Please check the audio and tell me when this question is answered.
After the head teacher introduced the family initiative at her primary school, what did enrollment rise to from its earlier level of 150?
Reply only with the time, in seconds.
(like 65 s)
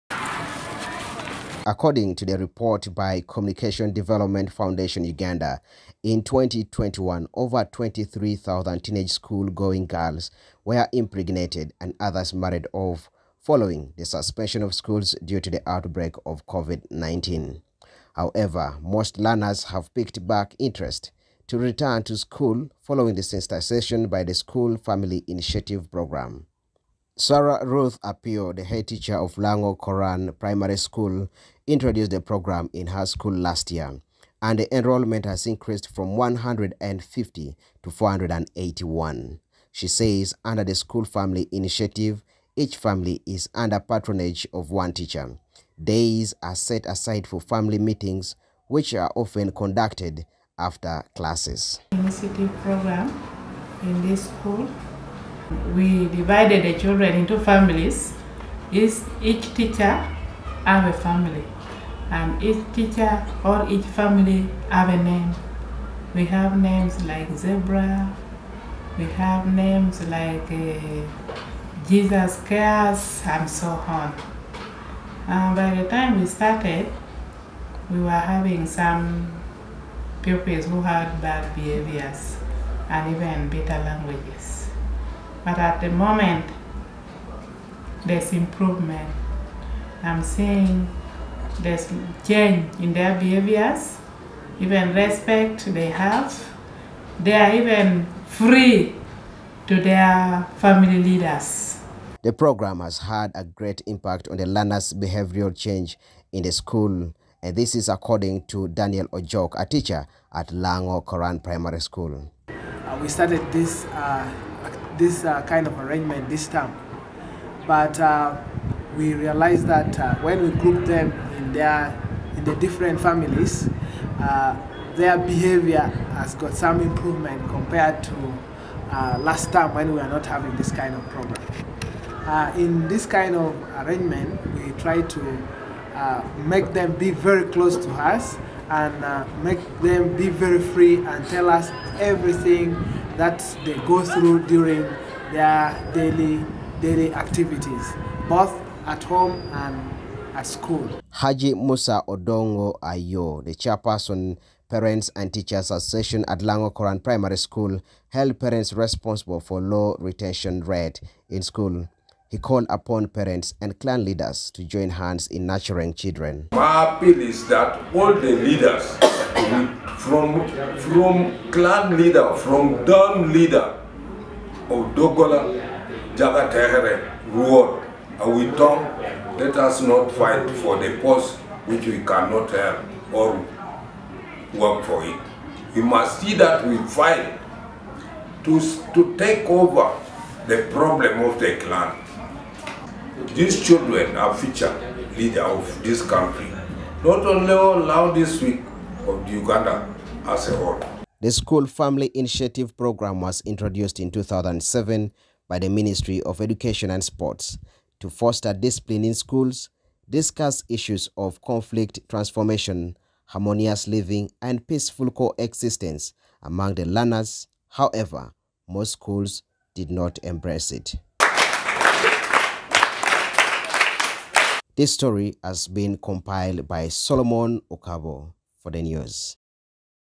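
37 s.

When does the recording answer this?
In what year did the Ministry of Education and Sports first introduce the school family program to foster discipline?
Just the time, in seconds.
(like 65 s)
204 s.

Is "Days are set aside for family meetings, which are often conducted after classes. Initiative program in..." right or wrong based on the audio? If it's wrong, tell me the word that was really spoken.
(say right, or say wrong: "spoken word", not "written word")
right.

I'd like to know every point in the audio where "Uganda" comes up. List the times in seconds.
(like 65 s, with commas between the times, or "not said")
5 s, 199 s.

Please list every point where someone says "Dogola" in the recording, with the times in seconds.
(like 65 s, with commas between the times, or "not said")
174 s.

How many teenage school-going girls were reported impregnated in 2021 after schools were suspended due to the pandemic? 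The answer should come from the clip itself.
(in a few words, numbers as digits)
over 23,000.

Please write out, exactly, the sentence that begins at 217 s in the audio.
However, most schools did not embrace it.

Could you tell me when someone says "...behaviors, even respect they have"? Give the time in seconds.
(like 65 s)
93 s.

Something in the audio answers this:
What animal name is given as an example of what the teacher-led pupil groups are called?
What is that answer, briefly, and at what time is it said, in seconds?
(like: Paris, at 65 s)
Zebra, at 67 s.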